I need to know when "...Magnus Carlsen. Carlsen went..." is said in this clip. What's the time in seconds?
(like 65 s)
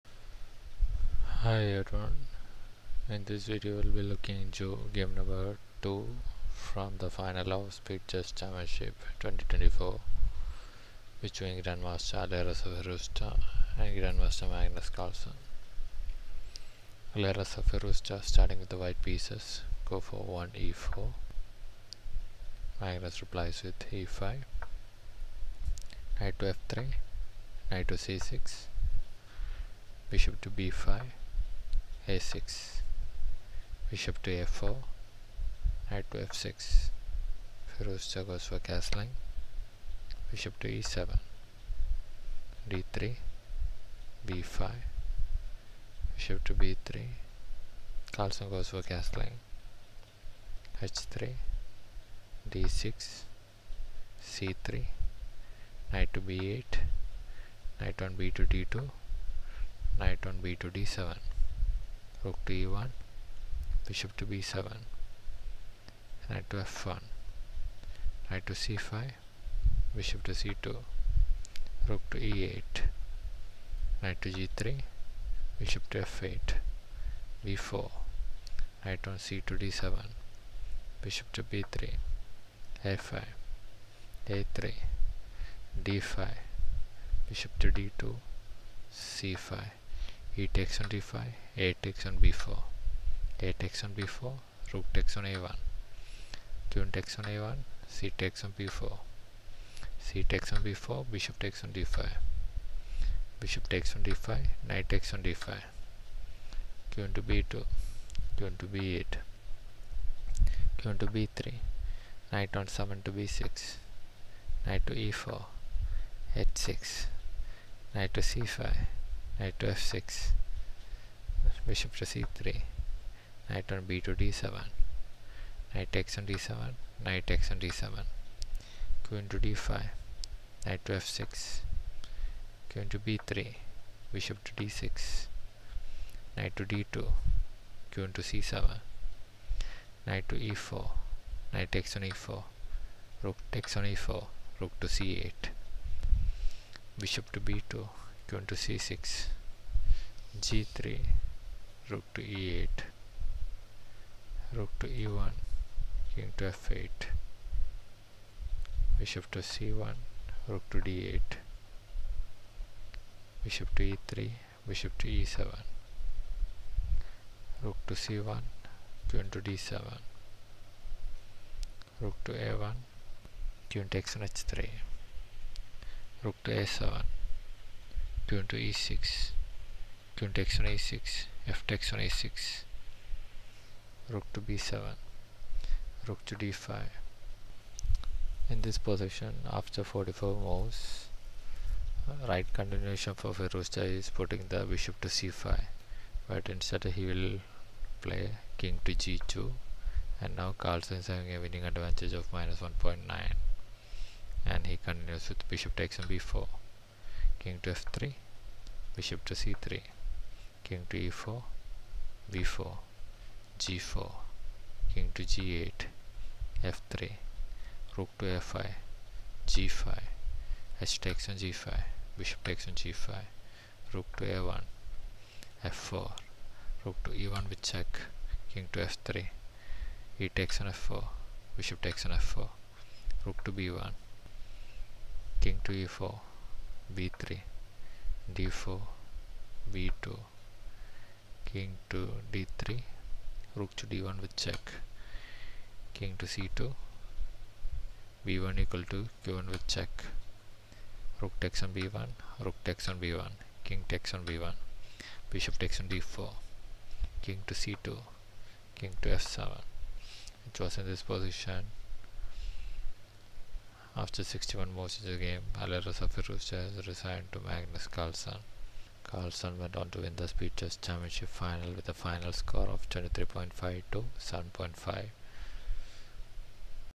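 267 s.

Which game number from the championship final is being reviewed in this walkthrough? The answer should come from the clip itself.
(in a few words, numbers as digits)
2.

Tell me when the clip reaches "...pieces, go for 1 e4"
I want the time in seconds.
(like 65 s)
19 s.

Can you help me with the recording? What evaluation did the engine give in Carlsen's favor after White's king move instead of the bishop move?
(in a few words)
-1.9.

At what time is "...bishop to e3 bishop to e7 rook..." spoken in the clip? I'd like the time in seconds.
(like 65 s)
163 s.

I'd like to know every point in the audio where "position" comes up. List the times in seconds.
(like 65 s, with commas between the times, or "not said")
188 s, 261 s.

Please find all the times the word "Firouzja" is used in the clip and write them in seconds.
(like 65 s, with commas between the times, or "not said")
37 s, 193 s, 266 s.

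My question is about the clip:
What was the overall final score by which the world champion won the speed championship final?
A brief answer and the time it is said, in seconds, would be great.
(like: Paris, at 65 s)
23.5 to 7.5, at 272 s.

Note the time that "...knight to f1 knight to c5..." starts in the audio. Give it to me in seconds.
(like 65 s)
66 s.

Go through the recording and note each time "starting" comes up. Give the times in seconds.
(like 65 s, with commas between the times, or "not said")
18 s.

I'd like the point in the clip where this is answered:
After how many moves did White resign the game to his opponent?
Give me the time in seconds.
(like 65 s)
264 s.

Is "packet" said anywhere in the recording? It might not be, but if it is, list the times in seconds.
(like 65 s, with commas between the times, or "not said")
not said.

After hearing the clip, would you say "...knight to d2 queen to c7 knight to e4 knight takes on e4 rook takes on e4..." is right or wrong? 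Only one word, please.
right.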